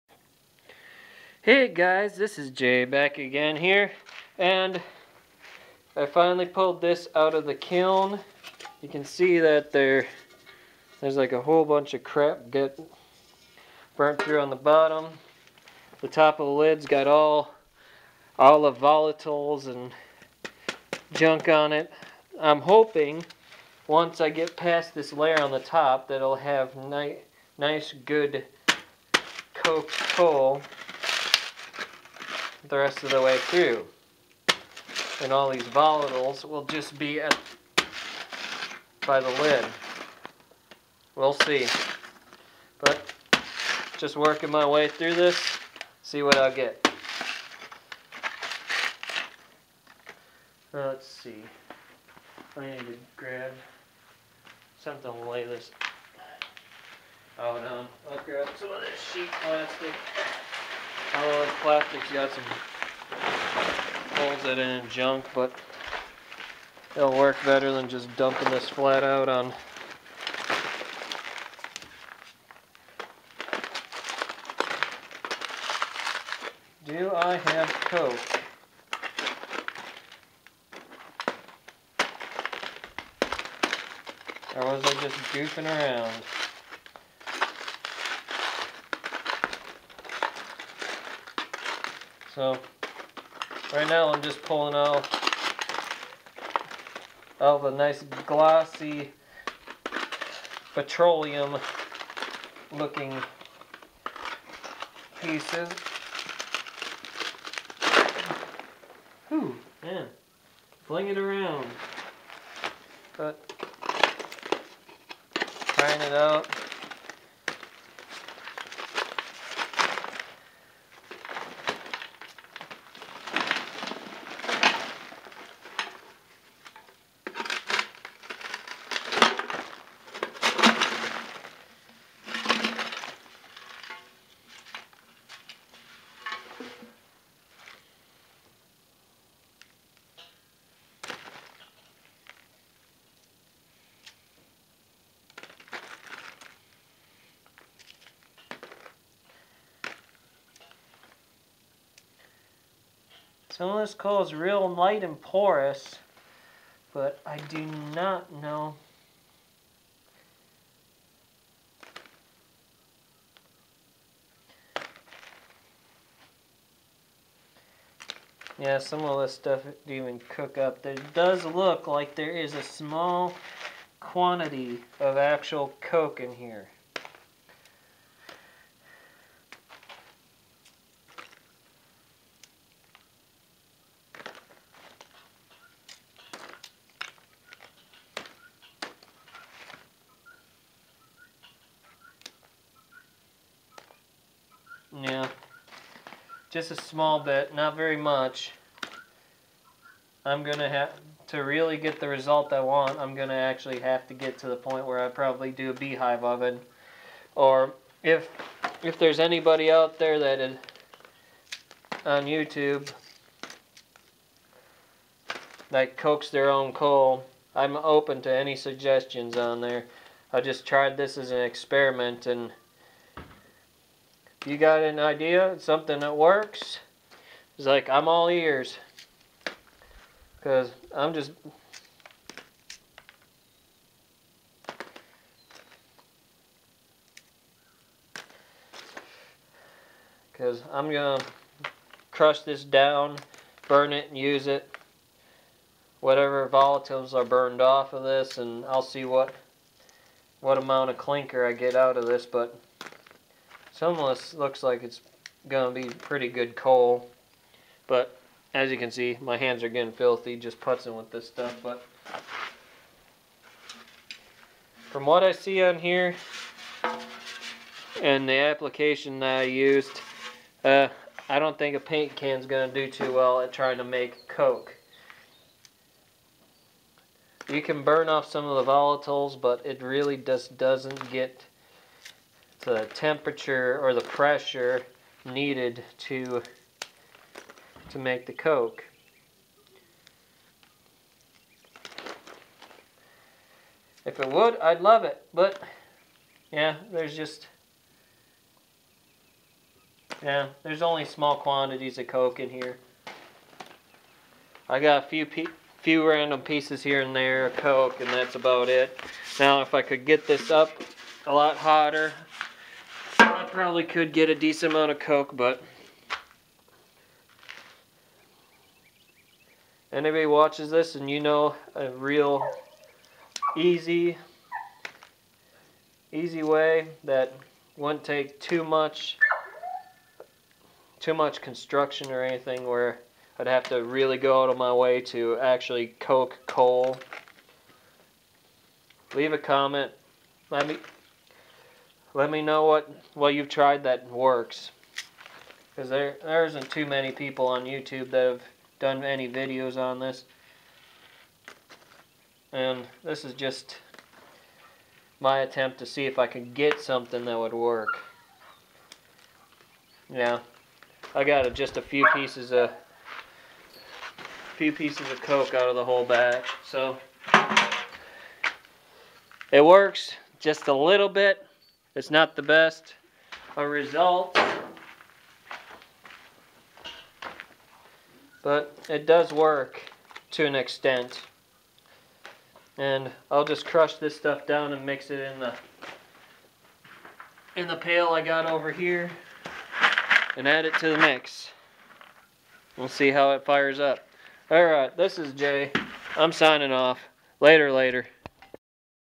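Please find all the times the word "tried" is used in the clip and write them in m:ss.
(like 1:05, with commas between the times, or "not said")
3:40, 5:43.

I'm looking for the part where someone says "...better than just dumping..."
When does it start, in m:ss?
1:07.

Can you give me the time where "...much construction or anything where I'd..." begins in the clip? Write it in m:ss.
5:31.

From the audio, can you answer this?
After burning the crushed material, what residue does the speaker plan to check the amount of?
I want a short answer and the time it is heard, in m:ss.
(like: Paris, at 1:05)
clinker, at 4:10.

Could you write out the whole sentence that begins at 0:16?
The top of the lid's got all, all the volatiles and junk on it.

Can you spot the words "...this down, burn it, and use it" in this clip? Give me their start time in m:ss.
4:02.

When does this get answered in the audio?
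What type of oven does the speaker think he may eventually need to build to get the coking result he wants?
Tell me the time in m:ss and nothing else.
3:25.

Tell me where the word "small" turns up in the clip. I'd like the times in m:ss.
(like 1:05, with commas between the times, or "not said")
2:52, 3:16, 5:01.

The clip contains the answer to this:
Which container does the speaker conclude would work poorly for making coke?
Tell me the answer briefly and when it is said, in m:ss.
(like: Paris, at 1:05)
paint can, at 4:31.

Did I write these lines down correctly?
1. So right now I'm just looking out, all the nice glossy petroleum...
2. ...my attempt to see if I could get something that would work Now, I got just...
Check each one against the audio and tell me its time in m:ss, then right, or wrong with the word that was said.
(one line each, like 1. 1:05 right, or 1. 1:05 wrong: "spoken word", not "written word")
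1. 1:32 wrong: "pulling", not "looking"
2. 5:55 right.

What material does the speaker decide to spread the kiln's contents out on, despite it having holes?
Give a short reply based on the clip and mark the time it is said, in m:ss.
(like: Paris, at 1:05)
sheet plastic, at 0:59.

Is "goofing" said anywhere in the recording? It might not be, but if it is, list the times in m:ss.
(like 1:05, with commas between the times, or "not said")
1:25.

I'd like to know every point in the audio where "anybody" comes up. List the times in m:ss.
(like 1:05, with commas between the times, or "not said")
3:29, 5:19.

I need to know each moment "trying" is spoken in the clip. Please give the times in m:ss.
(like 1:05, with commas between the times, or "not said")
1:55, 4:33.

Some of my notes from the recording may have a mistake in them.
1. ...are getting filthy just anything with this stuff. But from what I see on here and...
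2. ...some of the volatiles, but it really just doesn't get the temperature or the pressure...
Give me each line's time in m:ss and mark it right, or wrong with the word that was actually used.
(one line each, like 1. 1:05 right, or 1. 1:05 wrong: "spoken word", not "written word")
1. 4:19 wrong: "putzing", not "anything"
2. 4:38 right.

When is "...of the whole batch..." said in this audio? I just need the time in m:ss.
6:05.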